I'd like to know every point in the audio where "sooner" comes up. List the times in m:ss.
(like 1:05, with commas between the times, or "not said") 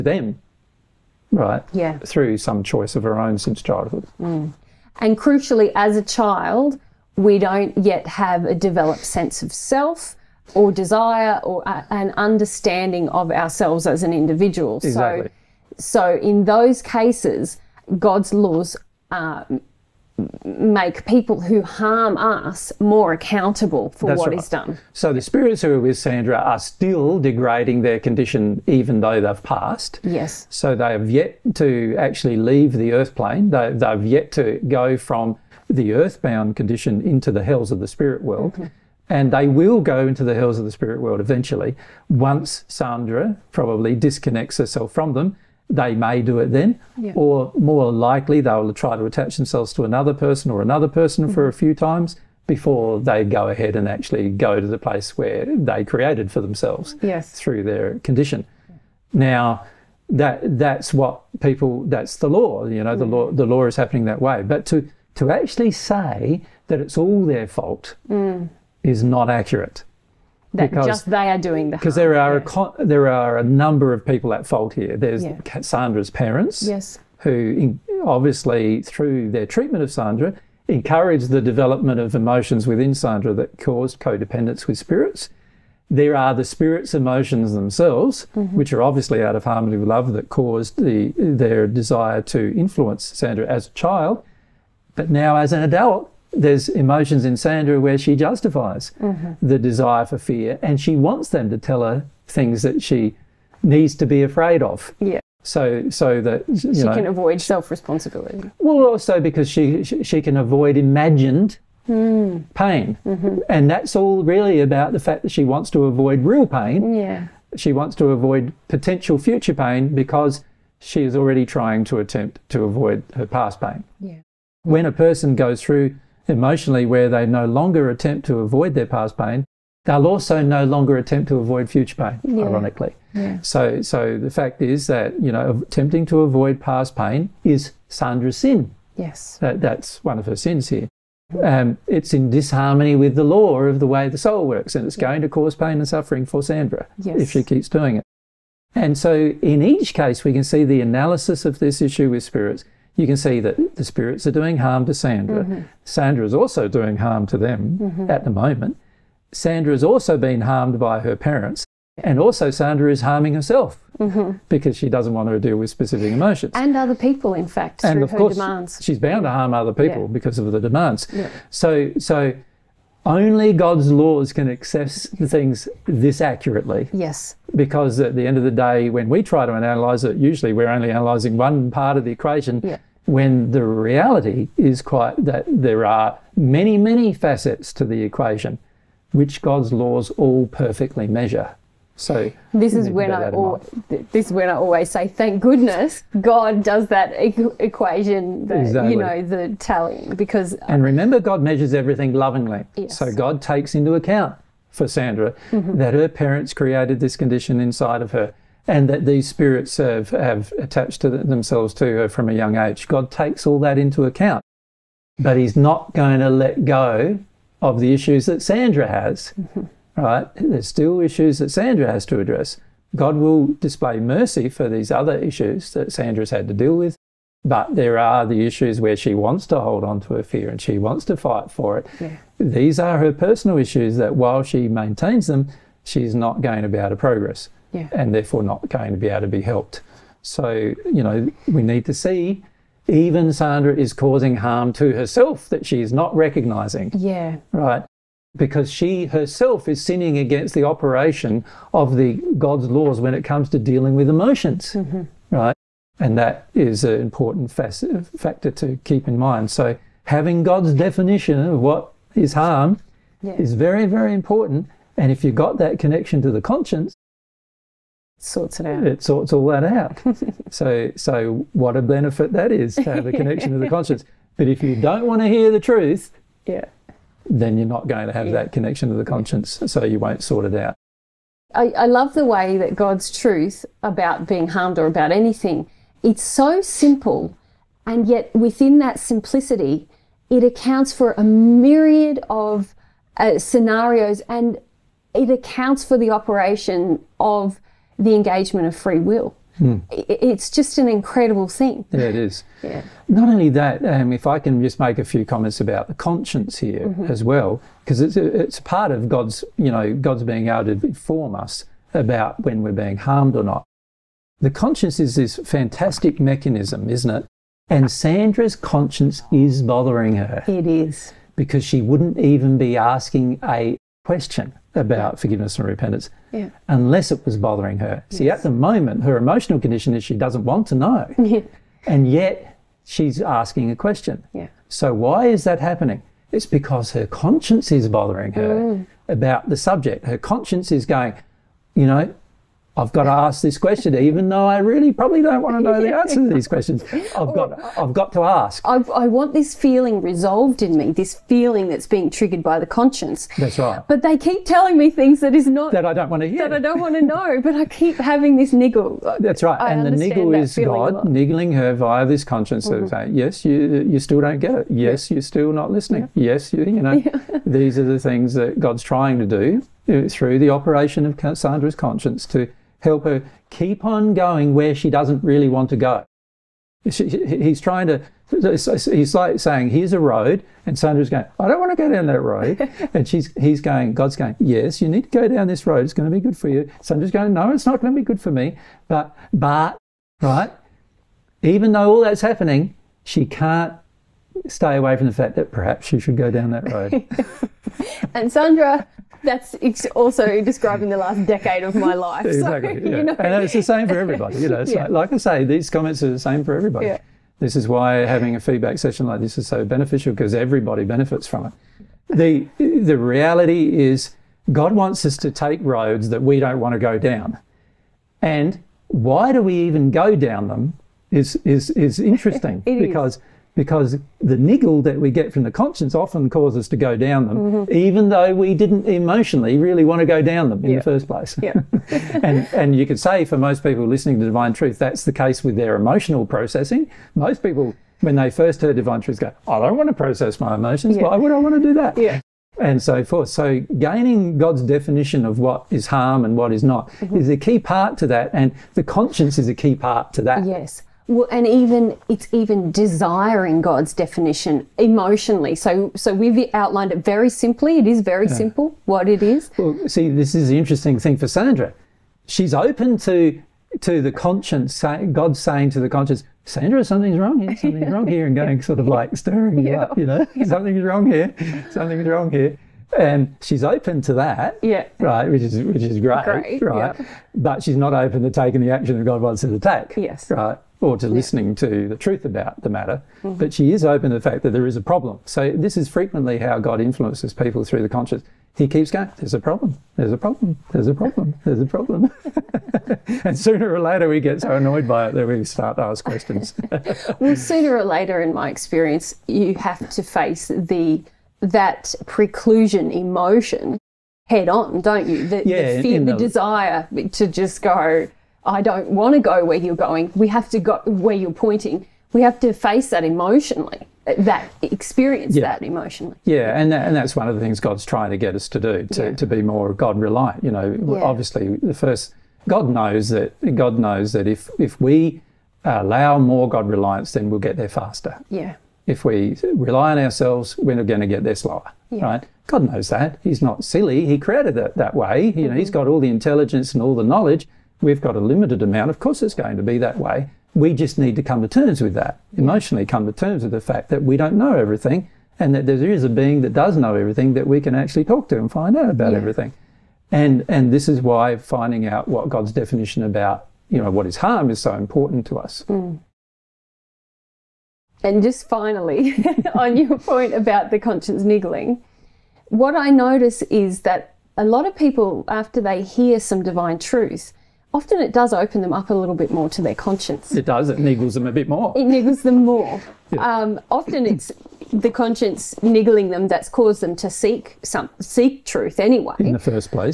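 8:13, 8:17.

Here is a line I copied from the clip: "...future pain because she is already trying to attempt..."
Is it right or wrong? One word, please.
right.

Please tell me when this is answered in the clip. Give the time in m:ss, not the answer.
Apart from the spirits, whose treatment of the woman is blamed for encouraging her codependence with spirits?
1:15.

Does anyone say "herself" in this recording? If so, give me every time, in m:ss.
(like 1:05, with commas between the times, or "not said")
0:44, 2:43, 4:04, 4:09.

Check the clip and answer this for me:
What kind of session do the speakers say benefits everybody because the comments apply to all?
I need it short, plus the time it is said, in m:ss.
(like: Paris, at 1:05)
feedback session, at 6:48.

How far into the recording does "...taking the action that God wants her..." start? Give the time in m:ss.
7:58.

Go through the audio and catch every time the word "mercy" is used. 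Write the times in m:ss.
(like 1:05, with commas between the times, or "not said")
3:43.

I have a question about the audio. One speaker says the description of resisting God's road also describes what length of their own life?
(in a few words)
the last decade.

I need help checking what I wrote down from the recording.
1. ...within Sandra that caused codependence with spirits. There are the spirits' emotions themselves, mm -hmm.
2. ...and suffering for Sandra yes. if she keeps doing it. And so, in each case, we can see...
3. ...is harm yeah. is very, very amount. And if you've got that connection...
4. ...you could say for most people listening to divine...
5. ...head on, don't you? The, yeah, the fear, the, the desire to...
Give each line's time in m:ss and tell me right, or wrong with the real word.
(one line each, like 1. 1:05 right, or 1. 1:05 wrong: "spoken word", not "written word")
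1. 1:22 right
2. 2:25 right
3. 4:22 wrong: "important", not "amount"
4. 7:12 right
5. 8:24 right.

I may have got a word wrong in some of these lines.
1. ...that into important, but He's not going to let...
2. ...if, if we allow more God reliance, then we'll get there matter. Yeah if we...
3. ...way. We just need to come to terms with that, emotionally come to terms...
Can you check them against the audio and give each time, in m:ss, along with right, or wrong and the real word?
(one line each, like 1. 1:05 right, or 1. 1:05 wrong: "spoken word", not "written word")
1. 3:33 wrong: "account", not "important"
2. 8:44 wrong: "faster", not "matter"
3. 8:59 right.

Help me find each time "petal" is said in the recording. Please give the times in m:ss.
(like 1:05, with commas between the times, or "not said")
not said.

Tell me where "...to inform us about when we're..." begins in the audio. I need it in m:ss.
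5:10.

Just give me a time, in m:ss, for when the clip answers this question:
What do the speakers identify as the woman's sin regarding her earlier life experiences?
2:15.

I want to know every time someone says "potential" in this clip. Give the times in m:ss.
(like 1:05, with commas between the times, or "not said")
1:58.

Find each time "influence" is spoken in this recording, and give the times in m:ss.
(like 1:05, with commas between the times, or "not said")
1:32, 8:06.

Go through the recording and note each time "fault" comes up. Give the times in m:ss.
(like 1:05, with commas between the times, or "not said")
1:07, 1:14.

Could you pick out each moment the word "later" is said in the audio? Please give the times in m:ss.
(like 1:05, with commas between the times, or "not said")
8:13, 8:17.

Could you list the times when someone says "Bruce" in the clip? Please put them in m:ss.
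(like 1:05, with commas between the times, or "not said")
not said.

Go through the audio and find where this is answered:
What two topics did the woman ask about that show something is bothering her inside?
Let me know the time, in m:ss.
5:25.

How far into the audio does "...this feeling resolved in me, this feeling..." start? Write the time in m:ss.
5:49.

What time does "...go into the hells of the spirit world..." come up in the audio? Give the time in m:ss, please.
0:39.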